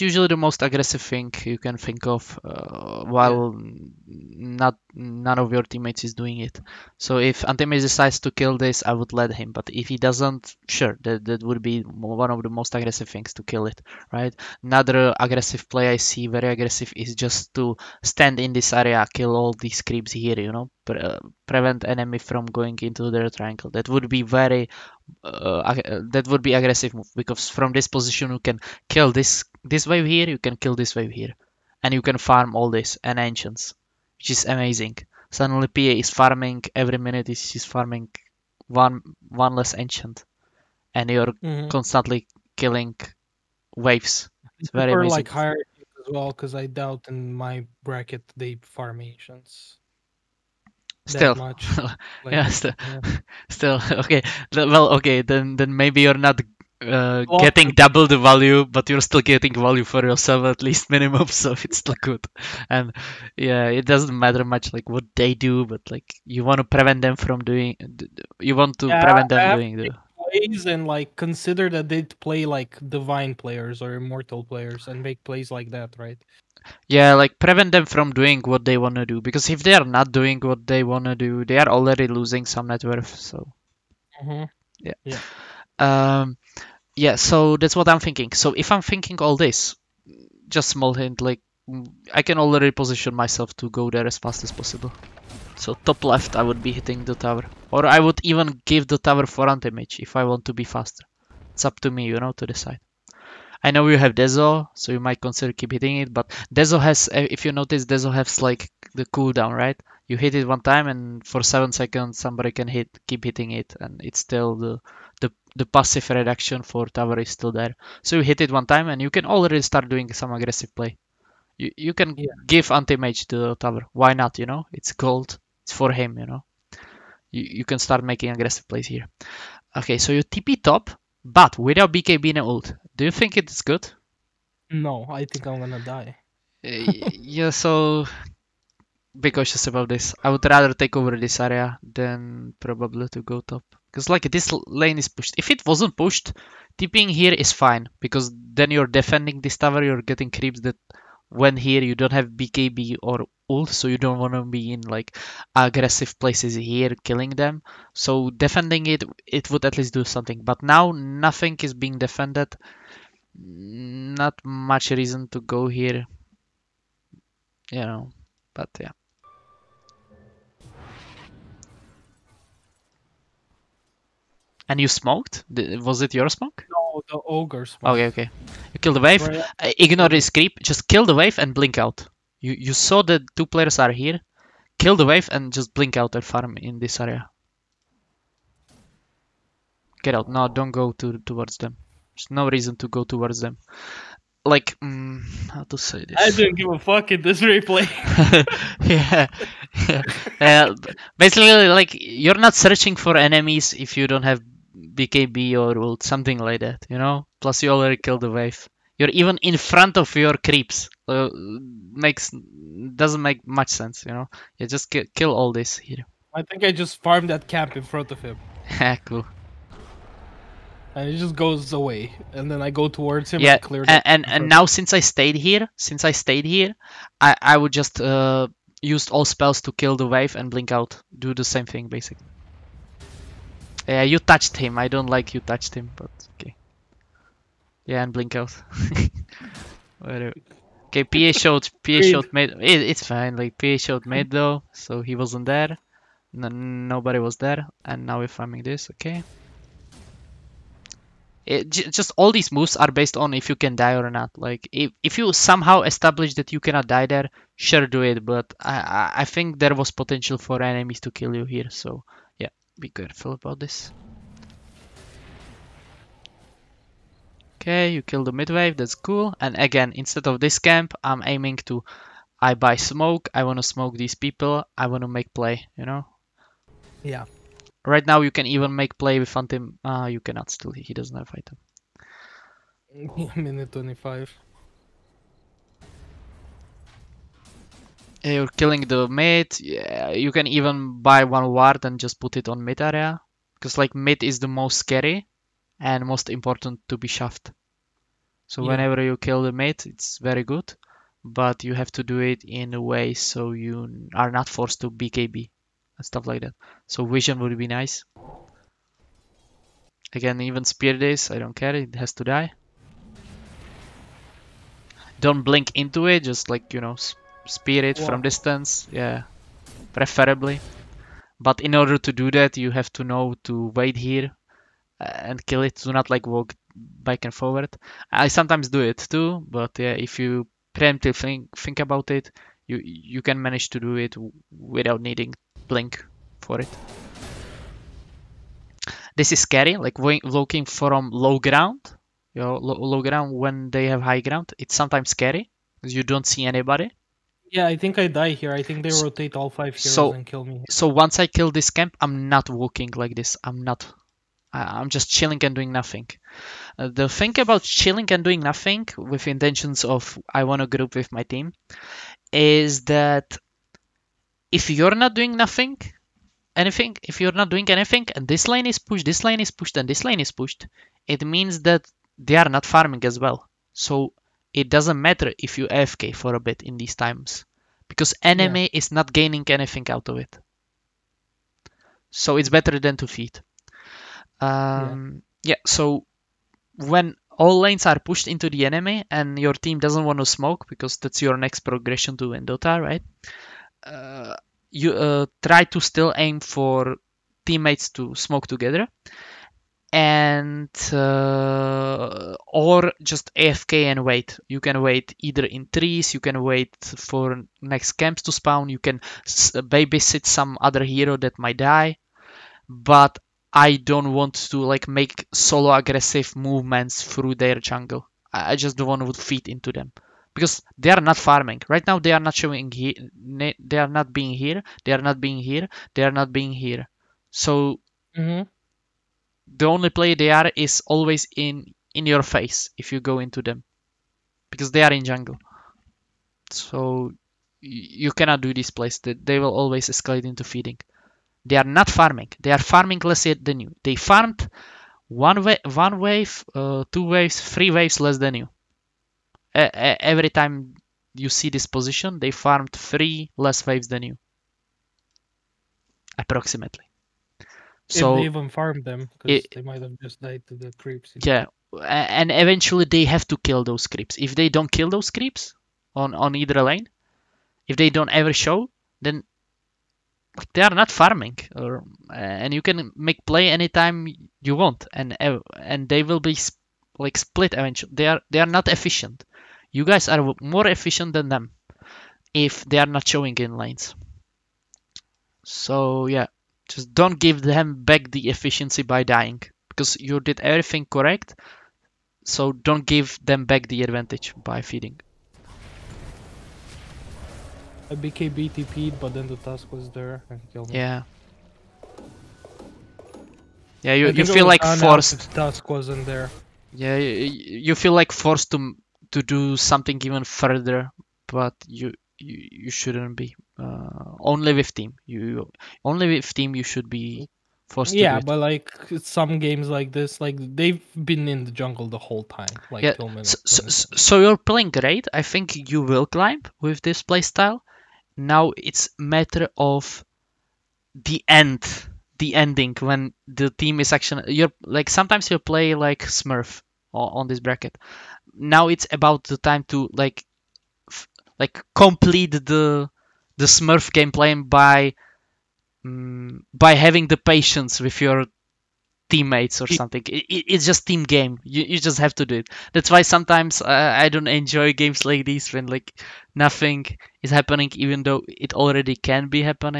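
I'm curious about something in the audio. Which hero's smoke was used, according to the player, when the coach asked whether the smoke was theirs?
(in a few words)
Ogre.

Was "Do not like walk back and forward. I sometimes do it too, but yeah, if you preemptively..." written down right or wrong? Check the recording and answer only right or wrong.
right.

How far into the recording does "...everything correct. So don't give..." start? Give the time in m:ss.
8:10.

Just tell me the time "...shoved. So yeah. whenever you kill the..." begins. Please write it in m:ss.
4:57.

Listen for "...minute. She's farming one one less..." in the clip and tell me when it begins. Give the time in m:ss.
0:36.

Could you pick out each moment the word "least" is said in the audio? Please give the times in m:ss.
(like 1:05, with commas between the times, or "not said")
1:00, 2:39.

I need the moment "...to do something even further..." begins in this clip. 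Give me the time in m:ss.
8:29.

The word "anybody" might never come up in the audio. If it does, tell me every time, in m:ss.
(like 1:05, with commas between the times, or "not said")
5:46.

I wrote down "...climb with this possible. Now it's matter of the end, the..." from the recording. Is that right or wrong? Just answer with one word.
wrong.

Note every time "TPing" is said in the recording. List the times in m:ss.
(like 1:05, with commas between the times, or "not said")
2:26.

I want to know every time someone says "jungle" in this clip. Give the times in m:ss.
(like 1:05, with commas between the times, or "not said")
6:57, 7:15, 8:41.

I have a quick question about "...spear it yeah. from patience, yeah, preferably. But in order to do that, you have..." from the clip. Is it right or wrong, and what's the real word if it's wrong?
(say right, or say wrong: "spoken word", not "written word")
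wrong: "distance", not "patience".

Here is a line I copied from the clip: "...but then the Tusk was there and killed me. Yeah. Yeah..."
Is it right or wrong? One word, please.
right.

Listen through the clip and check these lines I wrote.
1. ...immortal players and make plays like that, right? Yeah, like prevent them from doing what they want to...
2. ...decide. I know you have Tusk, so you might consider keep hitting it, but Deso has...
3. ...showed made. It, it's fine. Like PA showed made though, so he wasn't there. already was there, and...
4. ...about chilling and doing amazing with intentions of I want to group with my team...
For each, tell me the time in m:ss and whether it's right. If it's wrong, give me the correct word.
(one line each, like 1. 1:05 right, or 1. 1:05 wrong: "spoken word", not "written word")
1. 1:13 right
2. 1:42 wrong: "Deso", not "Tusk"
3. 4:02 wrong: "nobody", not "already"
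4. 5:57 wrong: "nothing", not "amazing".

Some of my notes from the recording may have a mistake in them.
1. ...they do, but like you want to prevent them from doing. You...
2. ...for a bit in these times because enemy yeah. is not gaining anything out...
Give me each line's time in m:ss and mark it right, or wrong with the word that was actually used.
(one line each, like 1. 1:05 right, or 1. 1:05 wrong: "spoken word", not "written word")
1. 1:05 right
2. 6:16 right.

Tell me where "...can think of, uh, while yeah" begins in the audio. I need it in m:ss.
0:01.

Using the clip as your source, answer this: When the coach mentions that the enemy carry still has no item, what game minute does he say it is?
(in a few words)
Minute 25.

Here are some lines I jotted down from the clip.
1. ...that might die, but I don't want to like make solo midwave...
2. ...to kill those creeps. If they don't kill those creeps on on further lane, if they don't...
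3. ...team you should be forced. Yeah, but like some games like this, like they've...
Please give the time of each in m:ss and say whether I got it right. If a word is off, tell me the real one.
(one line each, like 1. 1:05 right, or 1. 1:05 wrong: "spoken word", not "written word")
1. 6:51 wrong: "aggressive", not "midwave"
2. 7:43 wrong: "either", not "further"
3. 8:36 right.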